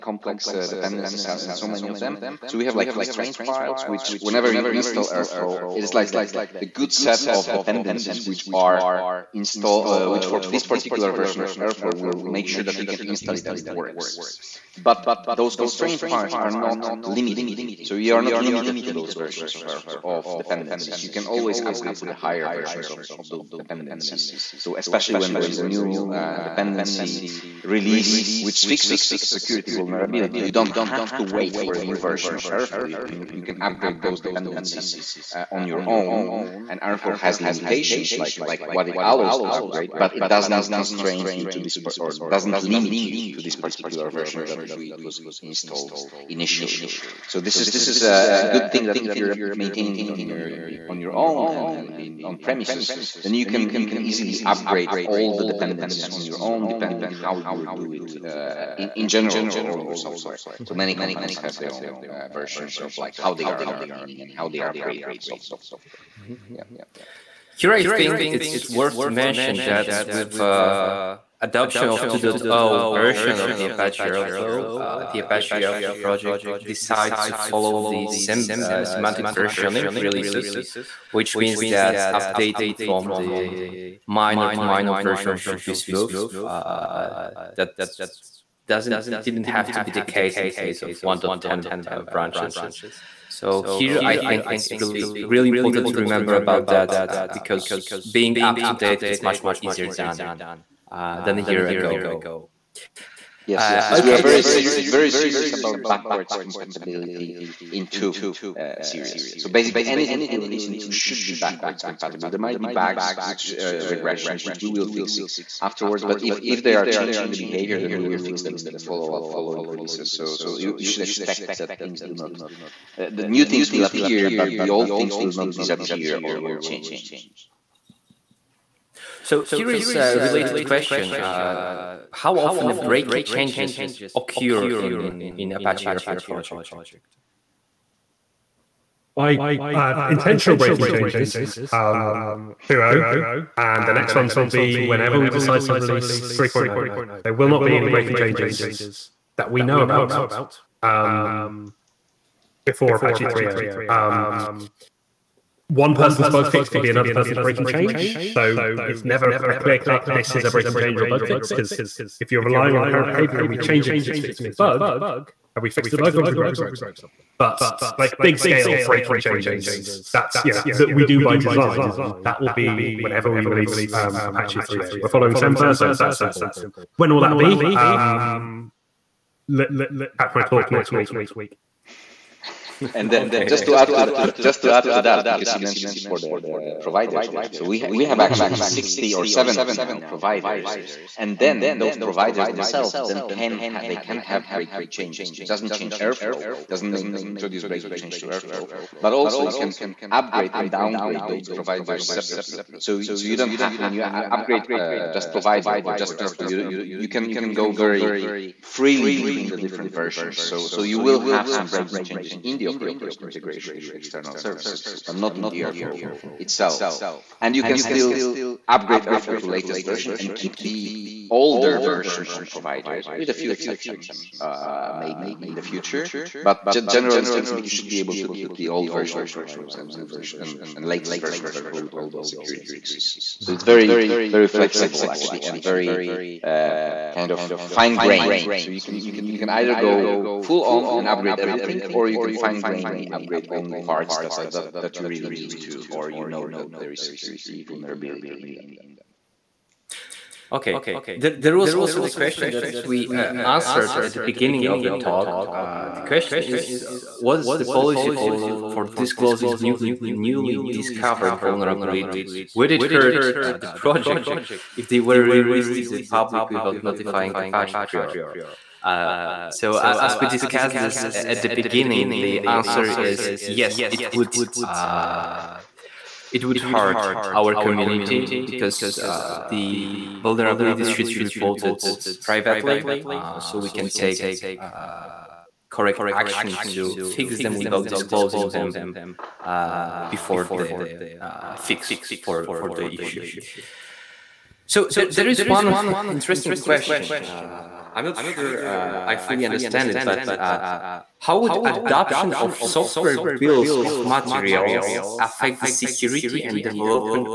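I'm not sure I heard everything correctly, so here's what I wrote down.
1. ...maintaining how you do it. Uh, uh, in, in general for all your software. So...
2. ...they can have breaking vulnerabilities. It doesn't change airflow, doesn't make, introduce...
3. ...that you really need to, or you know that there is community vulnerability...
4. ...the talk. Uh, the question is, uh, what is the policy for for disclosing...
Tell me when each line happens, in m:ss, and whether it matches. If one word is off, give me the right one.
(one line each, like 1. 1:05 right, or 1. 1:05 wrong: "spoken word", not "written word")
1. 0:56 wrong: "depending", not "maintaining"
2. 3:13 wrong: "changes", not "vulnerabilities"
3. 4:04 wrong: "security", not "community"
4. 4:14 right.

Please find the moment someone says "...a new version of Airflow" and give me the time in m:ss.
0:31.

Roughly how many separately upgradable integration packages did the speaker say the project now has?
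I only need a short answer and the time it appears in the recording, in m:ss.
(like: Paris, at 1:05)
60 or 70, at 3:08.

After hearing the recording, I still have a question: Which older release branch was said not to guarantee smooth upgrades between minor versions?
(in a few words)
1.10.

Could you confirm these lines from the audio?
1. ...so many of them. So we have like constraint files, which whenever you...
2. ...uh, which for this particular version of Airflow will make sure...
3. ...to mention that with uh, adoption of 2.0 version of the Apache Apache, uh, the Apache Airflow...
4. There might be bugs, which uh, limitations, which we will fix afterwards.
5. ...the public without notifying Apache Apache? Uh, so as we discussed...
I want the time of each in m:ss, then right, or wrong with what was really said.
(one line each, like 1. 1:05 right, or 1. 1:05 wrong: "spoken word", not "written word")
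1. 0:01 right
2. 0:09 right
3. 1:09 wrong: "Airflow", not "Apache"
4. 1:52 wrong: "regressions", not "limitations"
5. 4:25 wrong: "Prior", not "Apache".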